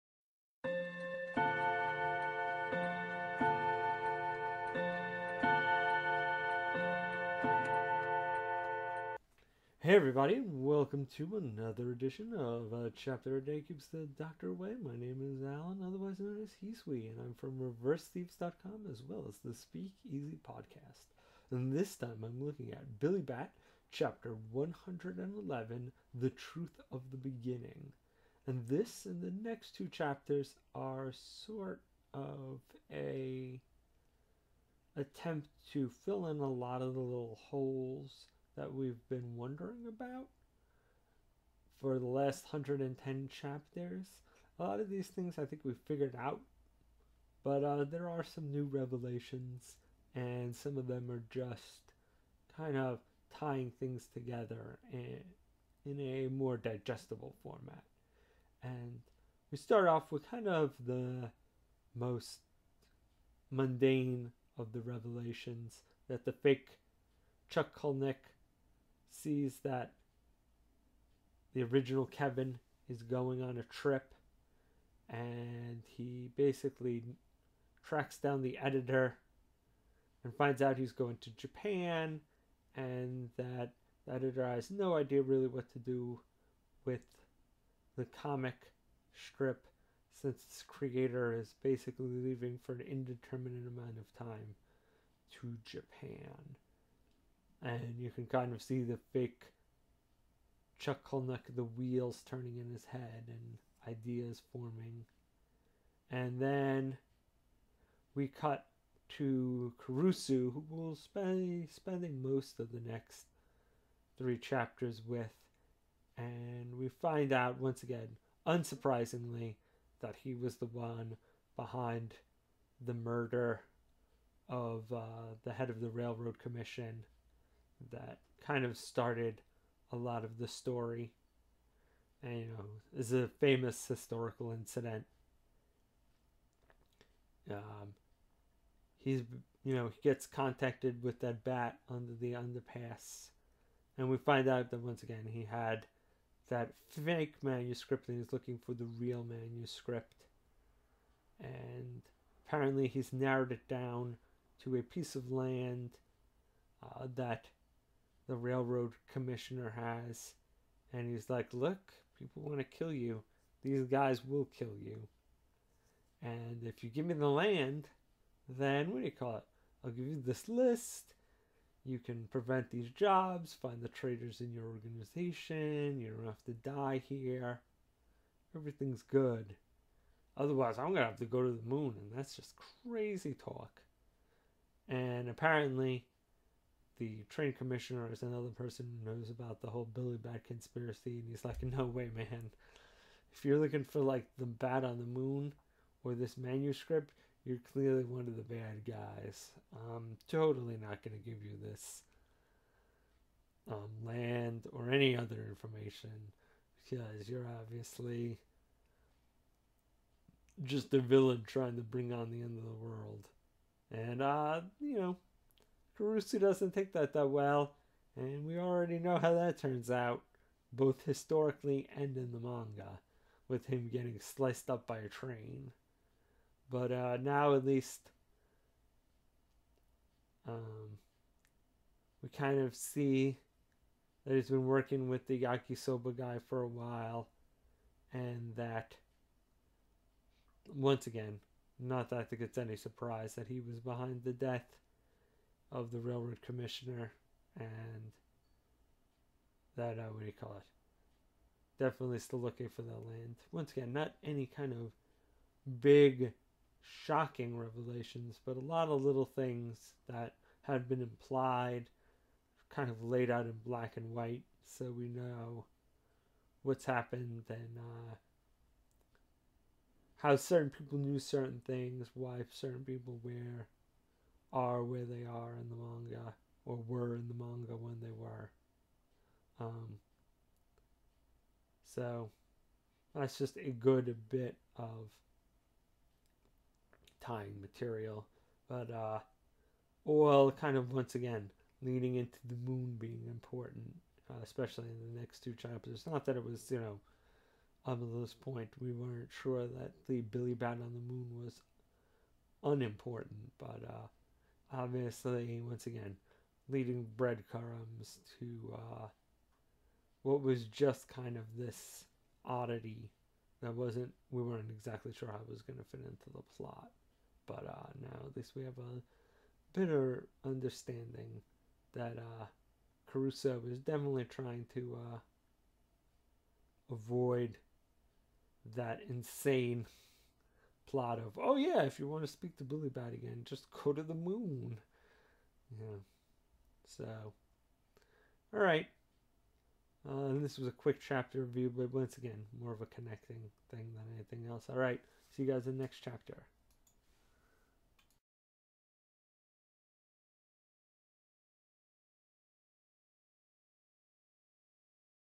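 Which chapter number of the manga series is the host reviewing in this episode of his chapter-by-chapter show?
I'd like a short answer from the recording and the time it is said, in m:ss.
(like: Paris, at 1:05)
111, at 0:23.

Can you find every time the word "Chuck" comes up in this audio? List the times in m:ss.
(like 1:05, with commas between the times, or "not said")
1:07, 1:40.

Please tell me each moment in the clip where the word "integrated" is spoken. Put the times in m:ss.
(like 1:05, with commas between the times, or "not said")
not said.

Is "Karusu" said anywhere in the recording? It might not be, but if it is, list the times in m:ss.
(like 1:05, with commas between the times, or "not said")
1:49, 3:35.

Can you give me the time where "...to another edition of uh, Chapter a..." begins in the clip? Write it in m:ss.
0:11.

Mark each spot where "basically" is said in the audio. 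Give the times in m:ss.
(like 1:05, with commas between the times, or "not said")
1:16, 1:31.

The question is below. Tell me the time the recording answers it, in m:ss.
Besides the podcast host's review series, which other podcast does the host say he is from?
0:19.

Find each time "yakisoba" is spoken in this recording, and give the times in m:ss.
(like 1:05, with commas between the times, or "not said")
3:55.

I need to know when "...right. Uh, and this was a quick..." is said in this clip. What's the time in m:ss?
5:38.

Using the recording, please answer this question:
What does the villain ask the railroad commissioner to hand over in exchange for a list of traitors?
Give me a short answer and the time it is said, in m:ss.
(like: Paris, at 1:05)
a piece of land, at 2:34.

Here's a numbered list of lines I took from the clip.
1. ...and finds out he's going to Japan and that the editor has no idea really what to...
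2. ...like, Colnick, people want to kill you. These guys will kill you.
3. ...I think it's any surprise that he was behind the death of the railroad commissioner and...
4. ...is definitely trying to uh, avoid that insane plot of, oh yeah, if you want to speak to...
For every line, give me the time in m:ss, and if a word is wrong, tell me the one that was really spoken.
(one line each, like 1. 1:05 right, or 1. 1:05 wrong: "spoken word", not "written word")
1. 1:20 right
2. 2:41 wrong: "Look", not "Colnick"
3. 4:02 right
4. 5:23 right.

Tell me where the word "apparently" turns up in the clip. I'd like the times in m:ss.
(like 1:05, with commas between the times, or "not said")
2:32, 3:05.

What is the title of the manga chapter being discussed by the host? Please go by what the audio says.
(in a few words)
The Truth of the Beginning.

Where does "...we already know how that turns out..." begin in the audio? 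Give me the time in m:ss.
3:38.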